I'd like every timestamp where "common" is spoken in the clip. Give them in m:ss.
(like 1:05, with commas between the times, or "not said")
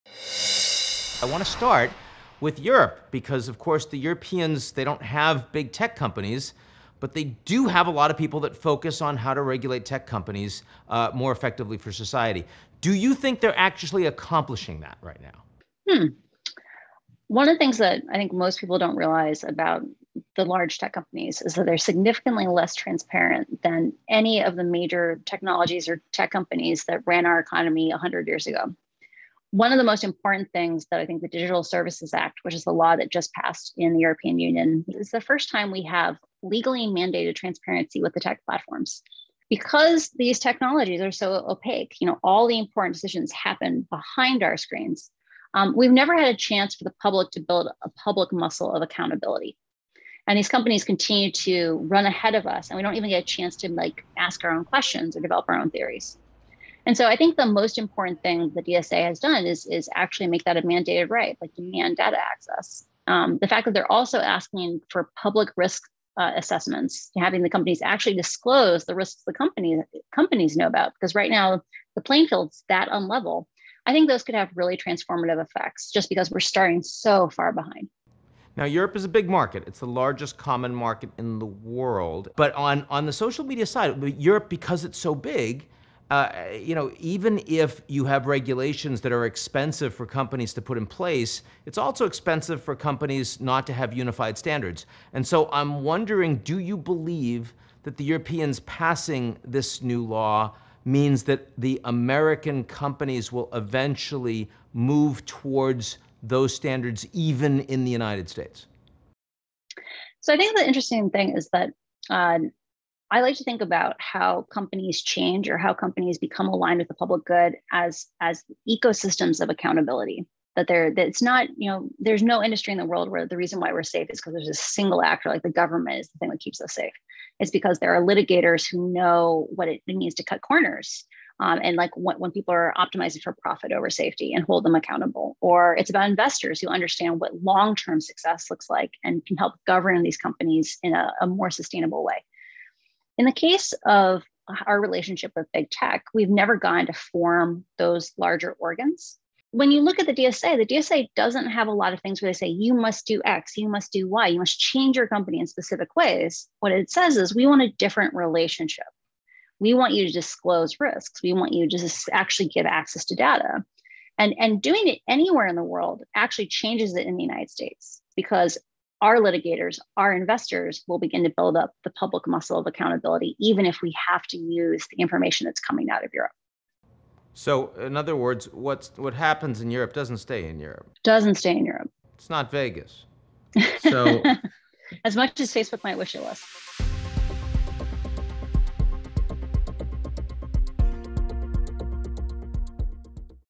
1:20.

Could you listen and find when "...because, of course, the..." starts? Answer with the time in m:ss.
0:03.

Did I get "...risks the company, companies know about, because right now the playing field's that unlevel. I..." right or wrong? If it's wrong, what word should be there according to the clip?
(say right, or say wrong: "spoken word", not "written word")
right.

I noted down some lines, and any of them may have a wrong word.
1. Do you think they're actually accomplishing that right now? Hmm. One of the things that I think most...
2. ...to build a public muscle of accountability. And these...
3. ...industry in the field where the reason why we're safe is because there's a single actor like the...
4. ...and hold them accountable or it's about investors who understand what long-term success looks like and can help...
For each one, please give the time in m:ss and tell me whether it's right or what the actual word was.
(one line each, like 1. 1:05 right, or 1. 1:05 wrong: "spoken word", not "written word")
1. 0:12 right
2. 0:47 right
3. 2:02 wrong: "world", not "field"
4. 2:14 right.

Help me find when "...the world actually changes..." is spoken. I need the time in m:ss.
2:45.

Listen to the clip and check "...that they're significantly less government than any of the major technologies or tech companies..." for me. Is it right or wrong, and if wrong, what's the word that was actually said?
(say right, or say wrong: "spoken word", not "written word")
wrong: "transparent", not "government".